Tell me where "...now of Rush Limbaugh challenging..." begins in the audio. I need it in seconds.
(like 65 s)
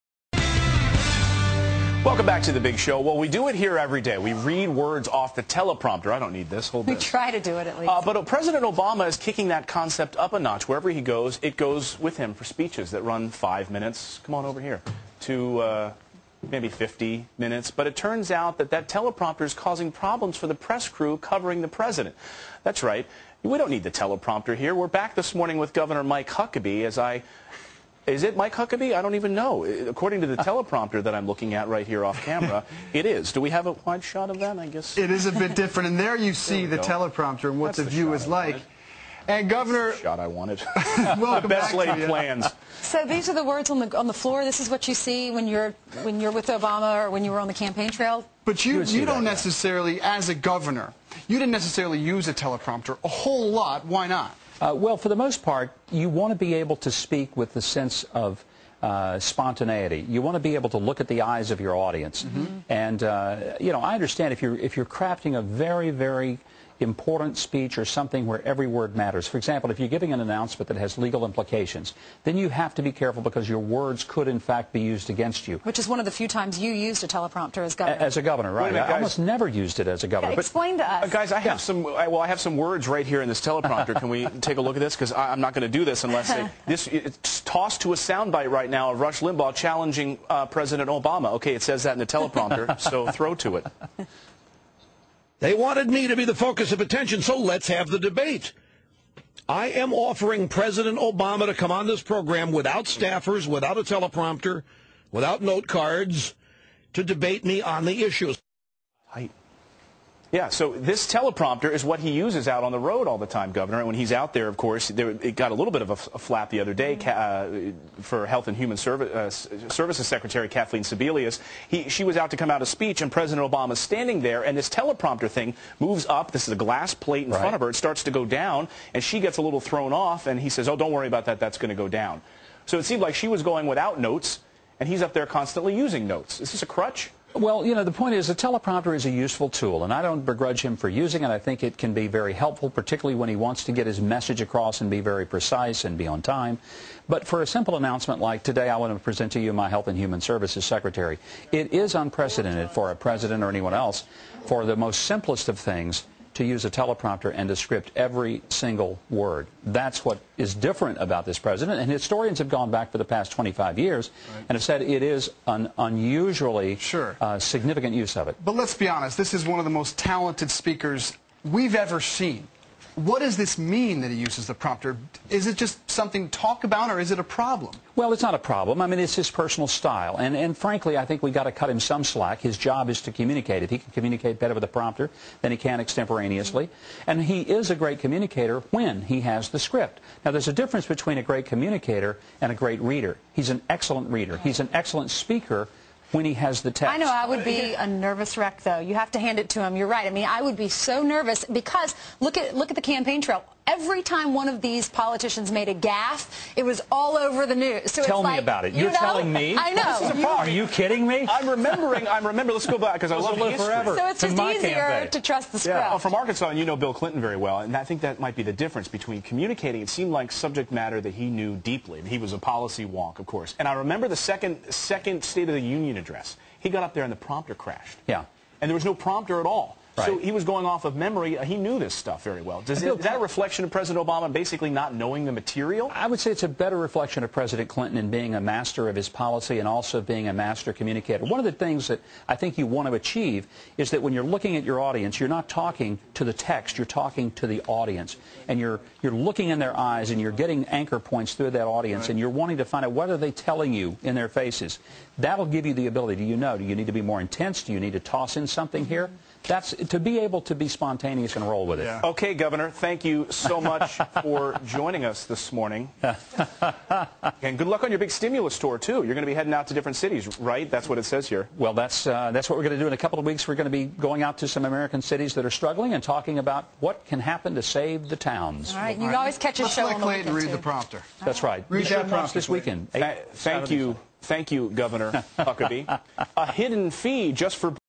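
88 s.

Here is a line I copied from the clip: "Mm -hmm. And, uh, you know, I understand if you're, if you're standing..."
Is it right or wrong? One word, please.
wrong.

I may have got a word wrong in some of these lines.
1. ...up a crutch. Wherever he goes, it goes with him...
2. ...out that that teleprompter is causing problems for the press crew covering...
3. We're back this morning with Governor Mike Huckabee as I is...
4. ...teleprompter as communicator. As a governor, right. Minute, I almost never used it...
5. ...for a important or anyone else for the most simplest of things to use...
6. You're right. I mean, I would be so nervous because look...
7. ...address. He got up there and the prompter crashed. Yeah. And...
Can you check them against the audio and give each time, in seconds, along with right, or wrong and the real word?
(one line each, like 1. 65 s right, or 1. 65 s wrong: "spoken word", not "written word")
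1. 10 s wrong: "notch", not "crutch"
2. 18 s right
3. 24 s right
4. 77 s wrong: "governor", not "communicator"
5. 152 s wrong: "president", not "important"
6. 199 s right
7. 225 s right.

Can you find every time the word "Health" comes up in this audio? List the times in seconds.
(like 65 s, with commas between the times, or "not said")
118 s, 149 s.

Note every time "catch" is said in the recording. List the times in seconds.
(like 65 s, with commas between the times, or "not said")
279 s.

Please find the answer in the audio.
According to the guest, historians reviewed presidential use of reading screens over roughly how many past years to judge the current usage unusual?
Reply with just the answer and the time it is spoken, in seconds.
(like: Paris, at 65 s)
25, at 163 s.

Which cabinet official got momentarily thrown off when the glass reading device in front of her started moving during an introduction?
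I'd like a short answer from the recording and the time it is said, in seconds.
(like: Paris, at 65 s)
Kathleen Sebelius, at 120 s.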